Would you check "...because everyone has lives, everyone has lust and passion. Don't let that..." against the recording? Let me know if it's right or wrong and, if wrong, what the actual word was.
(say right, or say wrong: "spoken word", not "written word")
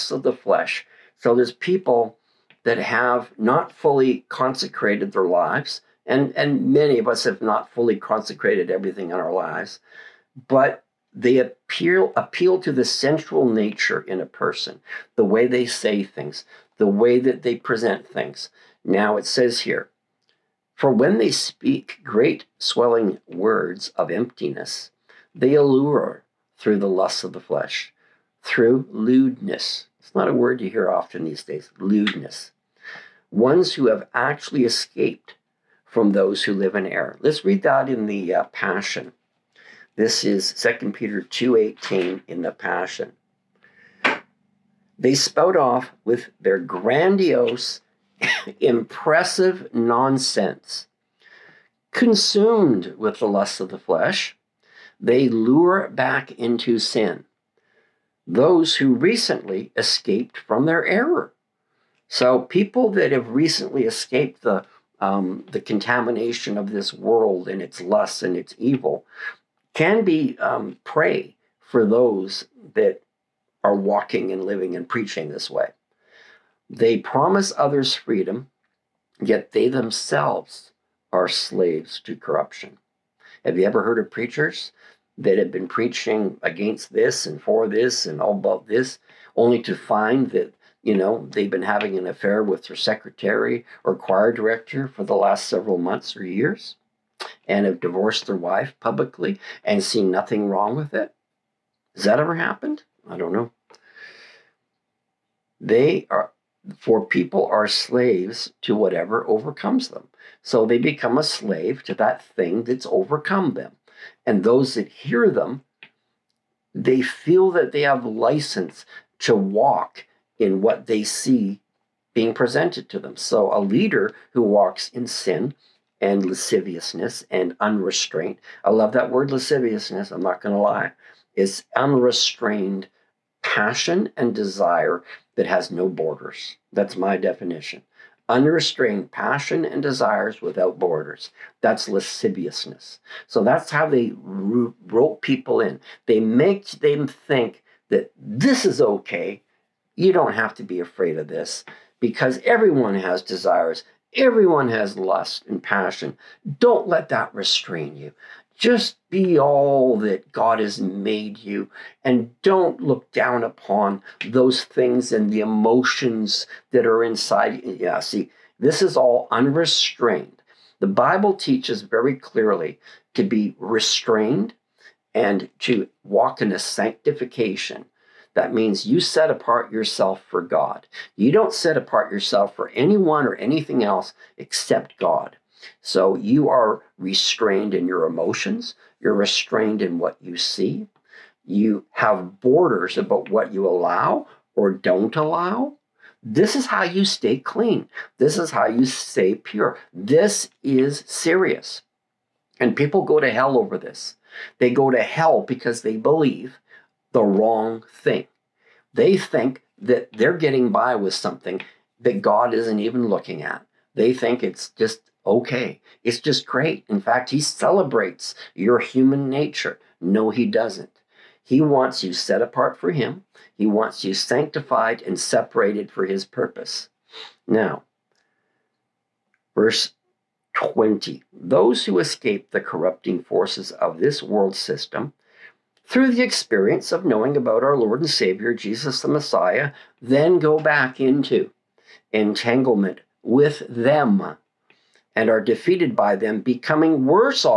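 wrong: "desires", not "lives".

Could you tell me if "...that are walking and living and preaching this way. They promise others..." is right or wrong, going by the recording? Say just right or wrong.
right.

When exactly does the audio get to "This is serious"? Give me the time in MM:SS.
03:19.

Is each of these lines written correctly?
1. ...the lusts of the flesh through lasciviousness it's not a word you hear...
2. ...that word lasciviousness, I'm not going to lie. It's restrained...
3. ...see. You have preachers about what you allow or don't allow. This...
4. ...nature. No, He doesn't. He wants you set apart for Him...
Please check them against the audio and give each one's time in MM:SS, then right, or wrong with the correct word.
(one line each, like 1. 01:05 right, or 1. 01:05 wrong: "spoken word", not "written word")
1. 00:26 wrong: "lewdness", not "lasciviousness"
2. 02:08 wrong: "unrestrained", not "restrained"
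3. 03:10 wrong: "borders", not "preachers"
4. 03:39 right.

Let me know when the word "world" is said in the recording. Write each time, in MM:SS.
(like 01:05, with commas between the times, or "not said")
01:06, 03:54.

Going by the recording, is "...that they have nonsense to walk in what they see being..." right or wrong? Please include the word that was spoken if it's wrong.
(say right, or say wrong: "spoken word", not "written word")
wrong: "license", not "nonsense".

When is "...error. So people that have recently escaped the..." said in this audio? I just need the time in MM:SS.
01:00.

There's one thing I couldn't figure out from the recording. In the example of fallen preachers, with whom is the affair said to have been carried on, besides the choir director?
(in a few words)
Their secretary.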